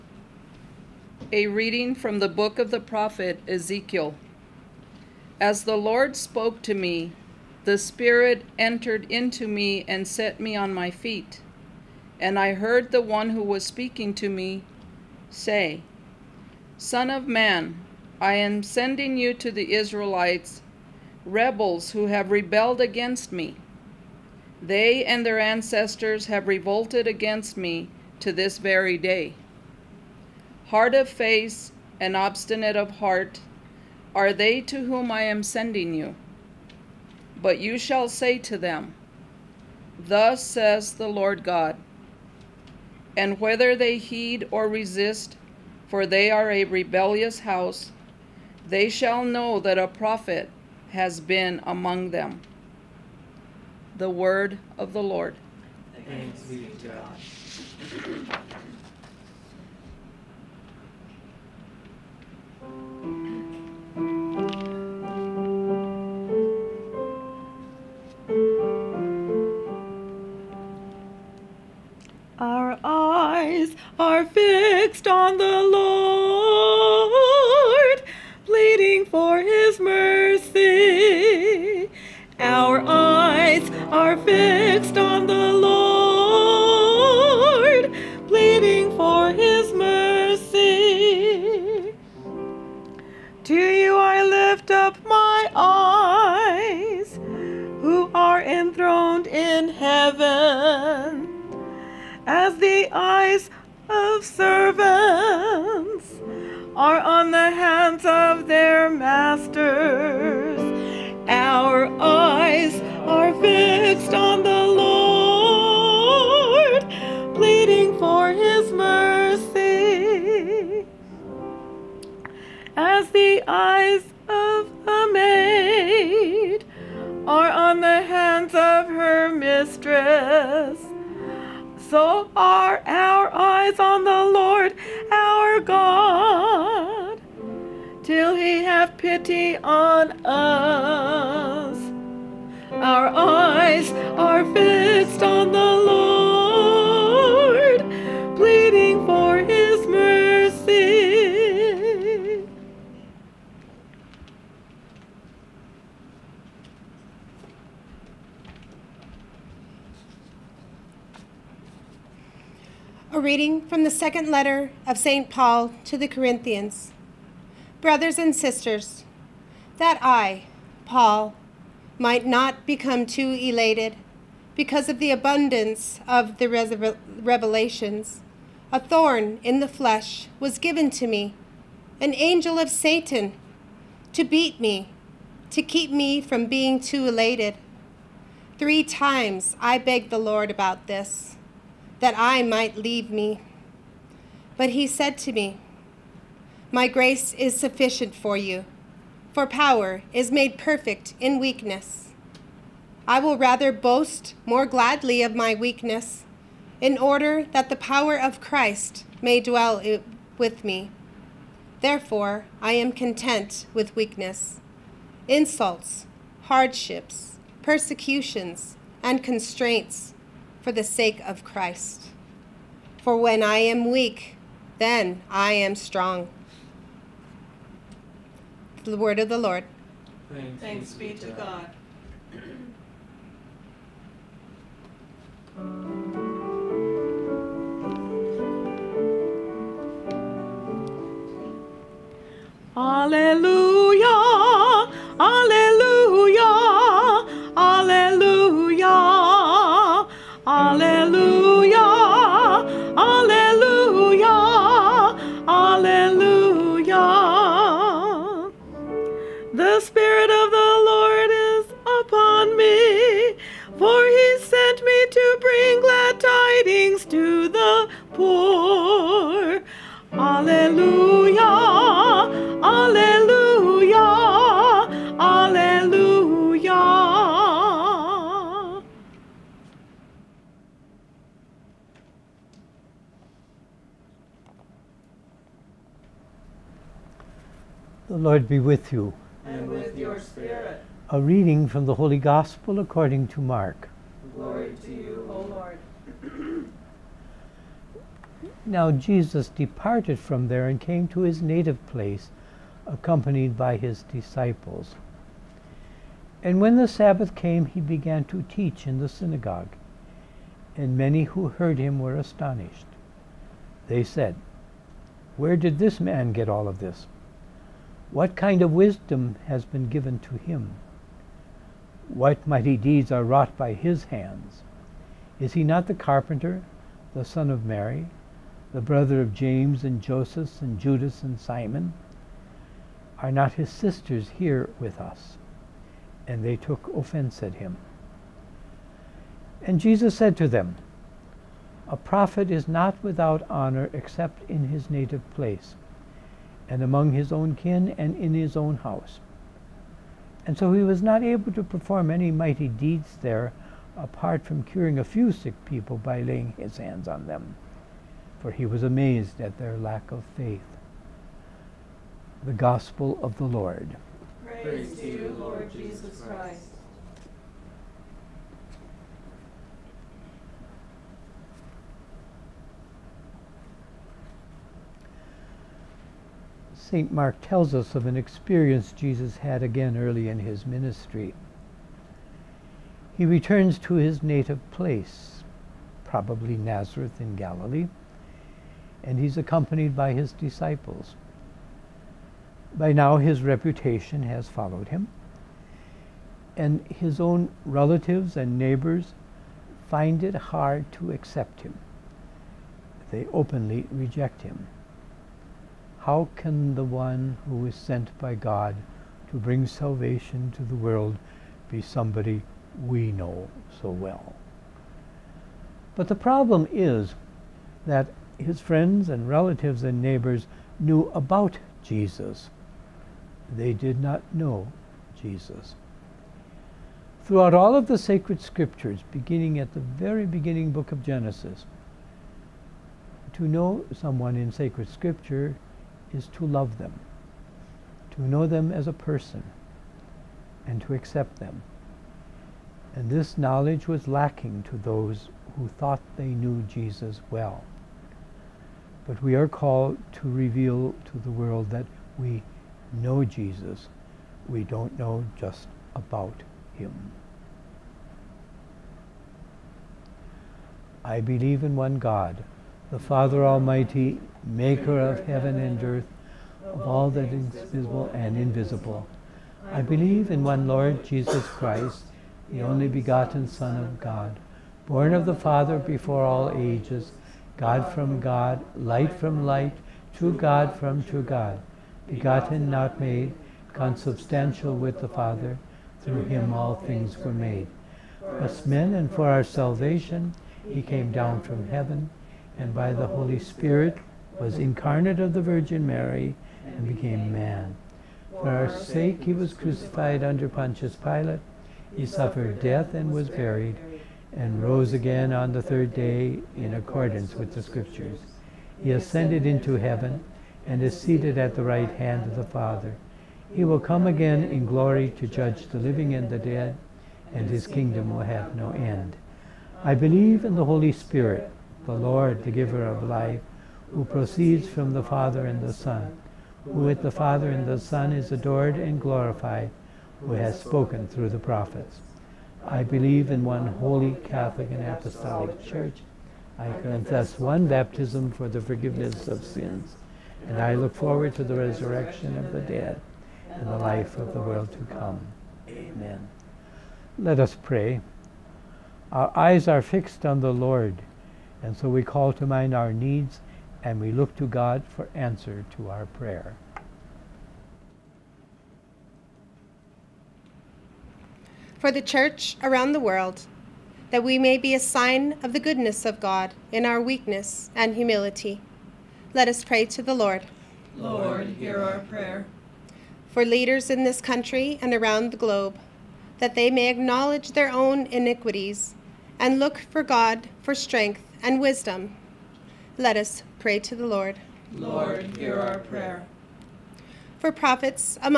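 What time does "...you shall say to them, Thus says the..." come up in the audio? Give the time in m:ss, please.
0:37.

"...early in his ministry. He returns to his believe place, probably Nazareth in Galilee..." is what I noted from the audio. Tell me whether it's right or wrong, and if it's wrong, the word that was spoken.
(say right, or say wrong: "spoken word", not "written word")
wrong: "native", not "believe".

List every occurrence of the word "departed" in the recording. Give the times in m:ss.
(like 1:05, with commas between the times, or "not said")
4:59.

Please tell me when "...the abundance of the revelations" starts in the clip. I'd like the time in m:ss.
2:54.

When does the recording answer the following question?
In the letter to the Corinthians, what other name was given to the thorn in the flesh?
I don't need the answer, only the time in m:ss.
3:01.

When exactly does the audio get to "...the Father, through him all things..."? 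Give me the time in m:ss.
8:04.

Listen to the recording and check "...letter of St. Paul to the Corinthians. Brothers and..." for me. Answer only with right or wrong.
right.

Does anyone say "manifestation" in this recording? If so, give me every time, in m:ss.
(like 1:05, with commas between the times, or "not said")
not said.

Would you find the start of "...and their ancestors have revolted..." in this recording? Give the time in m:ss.
0:25.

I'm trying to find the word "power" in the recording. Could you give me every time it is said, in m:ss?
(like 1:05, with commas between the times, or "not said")
3:19, 3:27.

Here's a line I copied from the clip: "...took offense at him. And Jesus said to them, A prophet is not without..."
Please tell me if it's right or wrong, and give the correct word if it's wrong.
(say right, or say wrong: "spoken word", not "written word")
right.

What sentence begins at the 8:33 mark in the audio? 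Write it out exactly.
He will come again in glory to judge the living and the dead, and his kingdom will have no end.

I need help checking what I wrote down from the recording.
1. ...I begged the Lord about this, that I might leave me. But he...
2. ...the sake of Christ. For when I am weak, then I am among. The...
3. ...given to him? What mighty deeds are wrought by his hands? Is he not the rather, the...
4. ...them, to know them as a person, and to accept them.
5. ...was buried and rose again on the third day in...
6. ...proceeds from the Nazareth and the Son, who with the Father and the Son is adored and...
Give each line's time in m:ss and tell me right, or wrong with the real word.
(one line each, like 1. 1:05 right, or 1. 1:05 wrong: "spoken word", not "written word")
1. 3:09 right
2. 3:40 wrong: "strong", not "among"
3. 5:19 wrong: "carpenter", not "rather"
4. 7:16 right
5. 8:23 right
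6. 8:44 wrong: "Father", not "Nazareth".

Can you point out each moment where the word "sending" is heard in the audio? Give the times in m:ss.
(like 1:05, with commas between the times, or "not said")
0:18, 0:35.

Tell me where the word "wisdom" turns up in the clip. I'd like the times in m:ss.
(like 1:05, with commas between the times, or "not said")
5:18, 9:41.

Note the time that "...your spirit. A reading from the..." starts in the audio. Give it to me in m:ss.
4:49.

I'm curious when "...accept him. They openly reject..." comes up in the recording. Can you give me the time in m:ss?
6:41.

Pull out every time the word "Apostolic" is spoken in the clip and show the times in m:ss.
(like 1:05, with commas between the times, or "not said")
8:54.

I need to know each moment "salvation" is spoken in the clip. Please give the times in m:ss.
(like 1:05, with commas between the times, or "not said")
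6:49, 8:09.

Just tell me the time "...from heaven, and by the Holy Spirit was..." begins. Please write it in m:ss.
8:11.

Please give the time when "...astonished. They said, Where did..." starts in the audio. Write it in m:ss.
5:12.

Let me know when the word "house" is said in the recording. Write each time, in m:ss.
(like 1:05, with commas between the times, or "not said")
0:47, 5:48.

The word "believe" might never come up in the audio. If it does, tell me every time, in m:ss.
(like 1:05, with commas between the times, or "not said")
7:41, 7:49, 8:39, 8:52.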